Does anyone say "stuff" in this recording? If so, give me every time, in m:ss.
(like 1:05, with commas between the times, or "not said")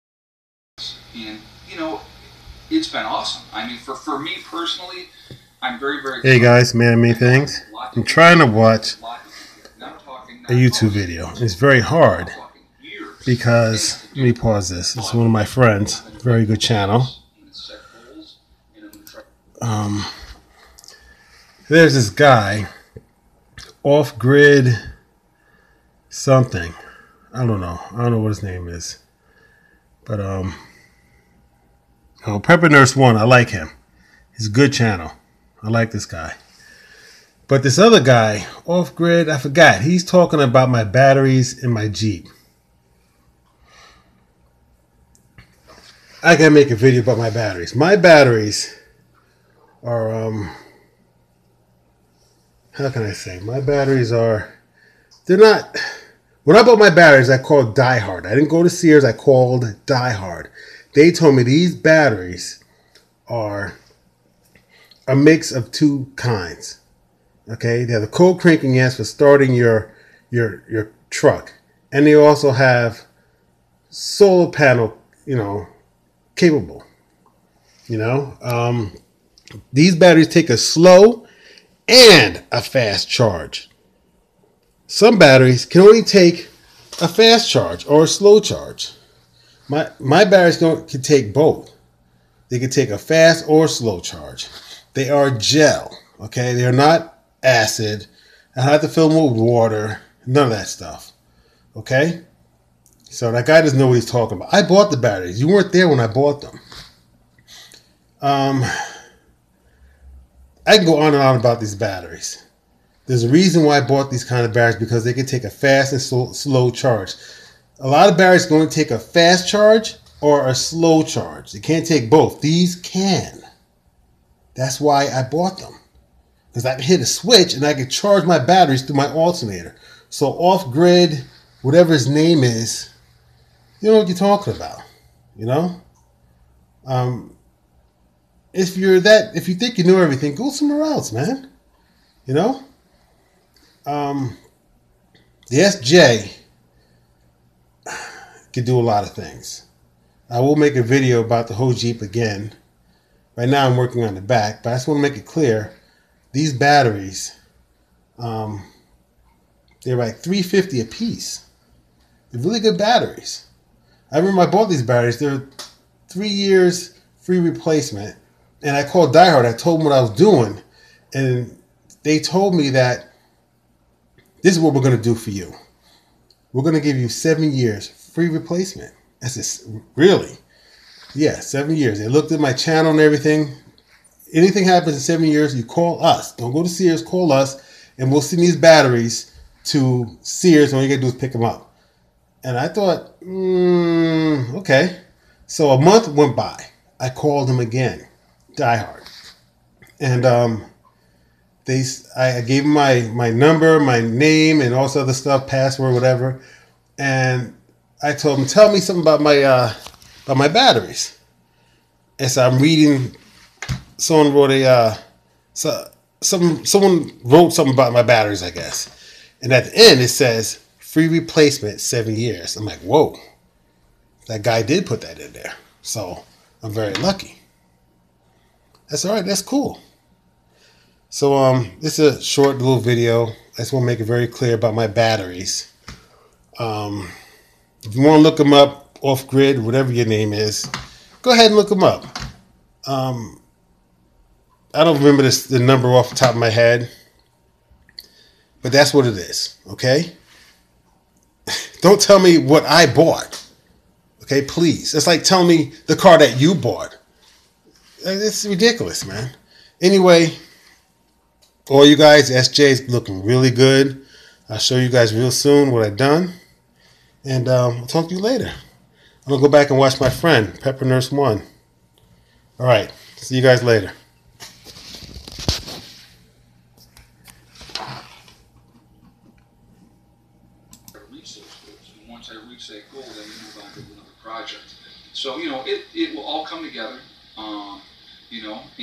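1:40, 3:25.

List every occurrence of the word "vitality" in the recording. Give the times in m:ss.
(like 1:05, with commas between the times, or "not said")
not said.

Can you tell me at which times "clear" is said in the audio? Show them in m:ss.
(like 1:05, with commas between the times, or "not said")
2:35, 3:54.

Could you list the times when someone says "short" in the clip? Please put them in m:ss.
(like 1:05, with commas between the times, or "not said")
3:52.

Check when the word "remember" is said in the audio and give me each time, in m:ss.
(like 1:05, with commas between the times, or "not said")
2:44, 4:04.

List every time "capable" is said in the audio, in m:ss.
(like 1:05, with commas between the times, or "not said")
1:16.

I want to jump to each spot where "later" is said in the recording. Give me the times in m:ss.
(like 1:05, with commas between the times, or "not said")
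4:28, 4:33.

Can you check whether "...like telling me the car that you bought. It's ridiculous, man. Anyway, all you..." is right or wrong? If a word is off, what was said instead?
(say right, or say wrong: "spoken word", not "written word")
right.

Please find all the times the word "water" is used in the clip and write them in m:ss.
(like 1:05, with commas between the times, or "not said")
1:39.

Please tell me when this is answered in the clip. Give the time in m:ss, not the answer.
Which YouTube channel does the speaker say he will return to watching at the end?
4:30.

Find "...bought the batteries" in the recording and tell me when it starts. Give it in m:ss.
1:44.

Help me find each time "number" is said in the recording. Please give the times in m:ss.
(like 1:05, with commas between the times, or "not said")
3:23, 4:05.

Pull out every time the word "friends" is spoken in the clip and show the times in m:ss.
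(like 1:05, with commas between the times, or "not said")
0:15, 4:30.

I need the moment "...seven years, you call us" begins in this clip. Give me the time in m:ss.
3:05.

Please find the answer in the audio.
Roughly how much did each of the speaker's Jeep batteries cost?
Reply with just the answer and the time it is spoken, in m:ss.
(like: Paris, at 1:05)
350, at 2:40.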